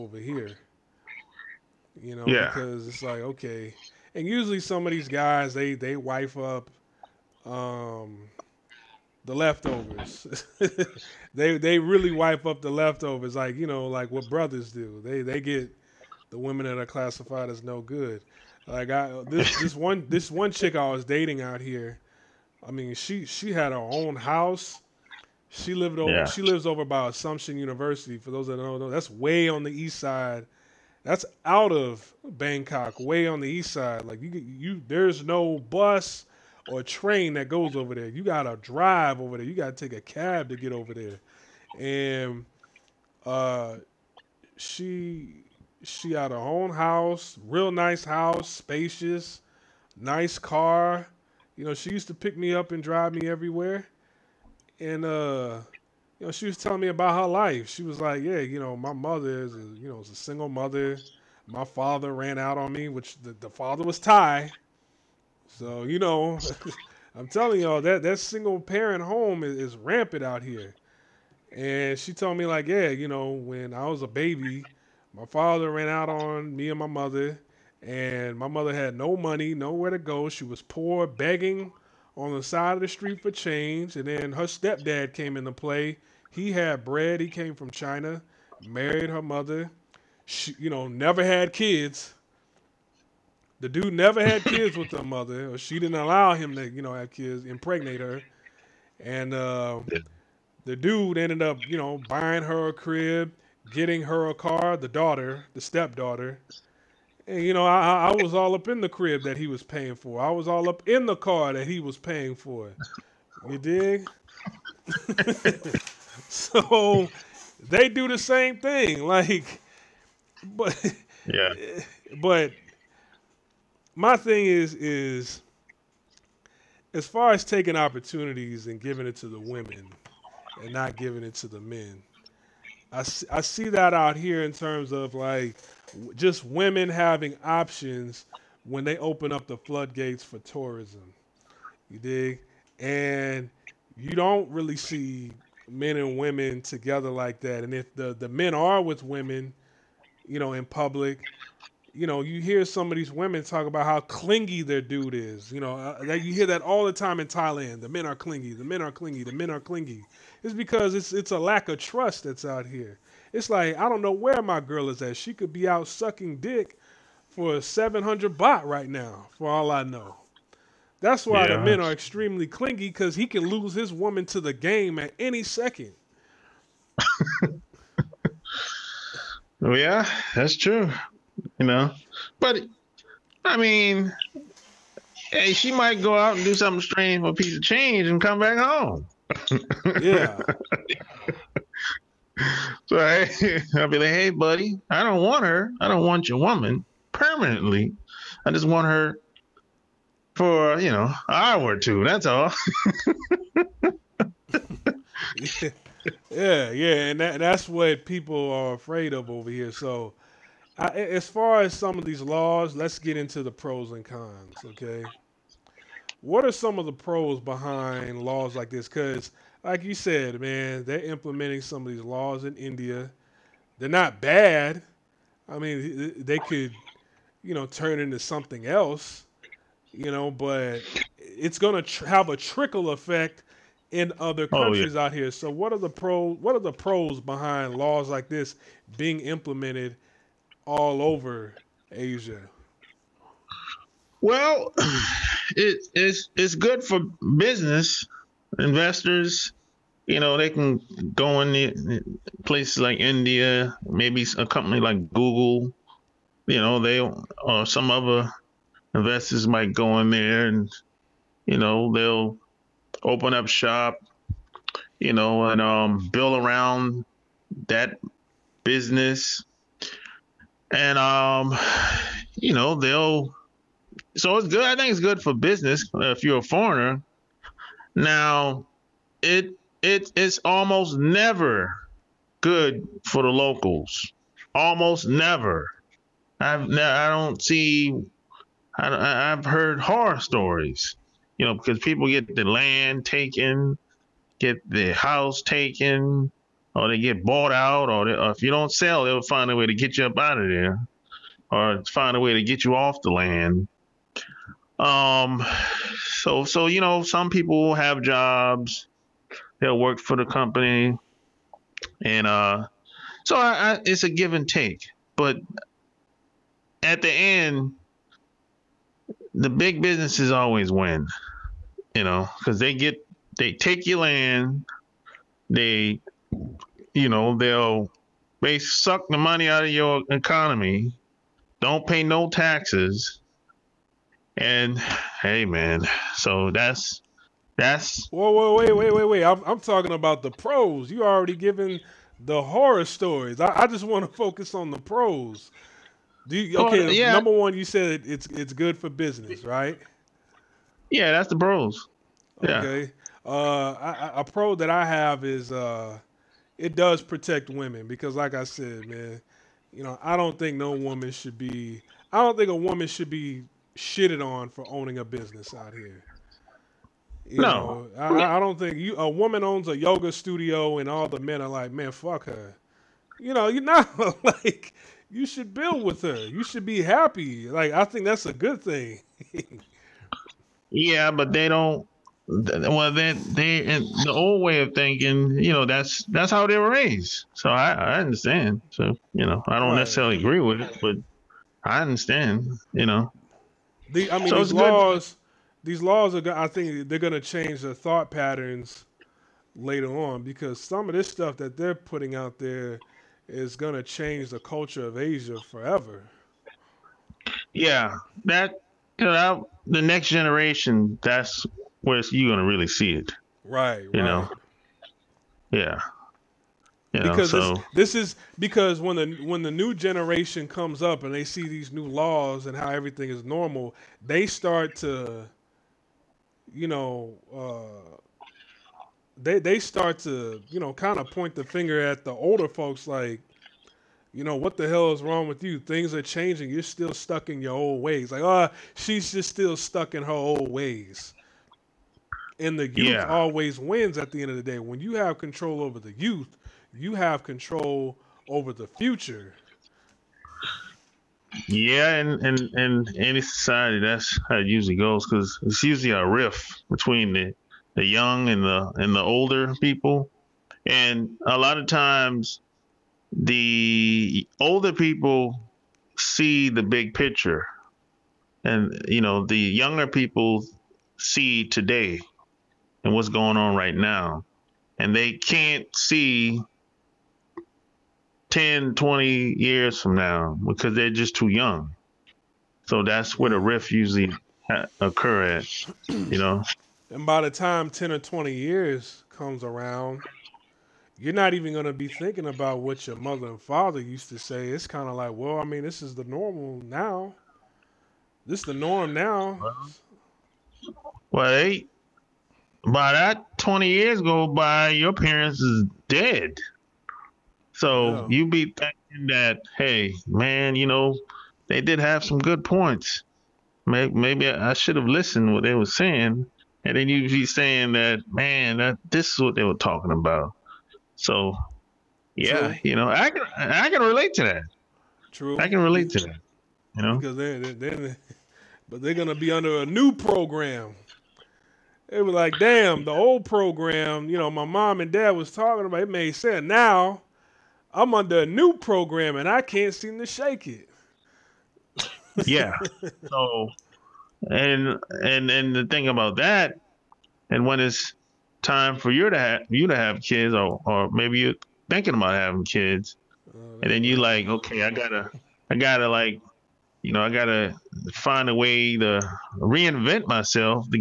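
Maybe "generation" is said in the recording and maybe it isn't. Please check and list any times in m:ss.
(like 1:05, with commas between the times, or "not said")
6:50, 6:59.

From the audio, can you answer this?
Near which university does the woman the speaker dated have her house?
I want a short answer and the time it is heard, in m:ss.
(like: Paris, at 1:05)
Assumption University, at 0:27.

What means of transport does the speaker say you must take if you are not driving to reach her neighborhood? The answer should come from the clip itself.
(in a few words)
a cab.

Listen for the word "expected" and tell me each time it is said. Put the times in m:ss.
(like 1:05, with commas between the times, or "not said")
not said.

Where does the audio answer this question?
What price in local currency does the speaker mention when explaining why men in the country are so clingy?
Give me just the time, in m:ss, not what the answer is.
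2:47.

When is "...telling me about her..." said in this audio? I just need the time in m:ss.
0:56.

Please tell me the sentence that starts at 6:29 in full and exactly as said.
necessarily agree with it but i understand you know the, i mean so these laws good.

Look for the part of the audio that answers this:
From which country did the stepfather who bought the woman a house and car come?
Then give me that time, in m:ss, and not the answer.
1:27.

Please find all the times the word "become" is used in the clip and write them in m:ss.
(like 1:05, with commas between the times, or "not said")
not said.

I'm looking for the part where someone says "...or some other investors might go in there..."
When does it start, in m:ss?
4:17.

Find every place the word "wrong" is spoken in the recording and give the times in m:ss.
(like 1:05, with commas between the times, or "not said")
7:15.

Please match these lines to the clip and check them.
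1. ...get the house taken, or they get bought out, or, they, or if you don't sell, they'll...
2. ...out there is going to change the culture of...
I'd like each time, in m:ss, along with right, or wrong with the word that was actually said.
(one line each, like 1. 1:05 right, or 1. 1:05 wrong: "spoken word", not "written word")
1. 4:54 right
2. 6:42 right.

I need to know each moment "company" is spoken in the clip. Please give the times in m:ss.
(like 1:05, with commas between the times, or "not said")
4:14, 5:10.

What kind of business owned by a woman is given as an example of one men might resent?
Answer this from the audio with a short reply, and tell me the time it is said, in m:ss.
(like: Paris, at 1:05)
yoga studio, at 6:09.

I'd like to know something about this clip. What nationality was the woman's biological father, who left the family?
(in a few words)
Thai.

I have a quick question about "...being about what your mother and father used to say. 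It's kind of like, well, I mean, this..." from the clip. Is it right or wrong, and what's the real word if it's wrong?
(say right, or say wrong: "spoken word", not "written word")
wrong: "thinking", not "being".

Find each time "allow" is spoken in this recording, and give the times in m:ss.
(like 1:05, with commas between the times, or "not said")
1:35.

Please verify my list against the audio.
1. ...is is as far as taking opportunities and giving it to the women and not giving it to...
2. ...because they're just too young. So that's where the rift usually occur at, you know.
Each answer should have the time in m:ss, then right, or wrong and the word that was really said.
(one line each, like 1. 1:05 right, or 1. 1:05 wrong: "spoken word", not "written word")
1. 2:04 right
2. 8:00 right.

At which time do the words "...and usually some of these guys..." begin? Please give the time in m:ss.
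0:04.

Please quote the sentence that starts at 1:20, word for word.
She was poor, begging on the side of the street for change.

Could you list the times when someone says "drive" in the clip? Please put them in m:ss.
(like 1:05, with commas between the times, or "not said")
0:38, 0:52.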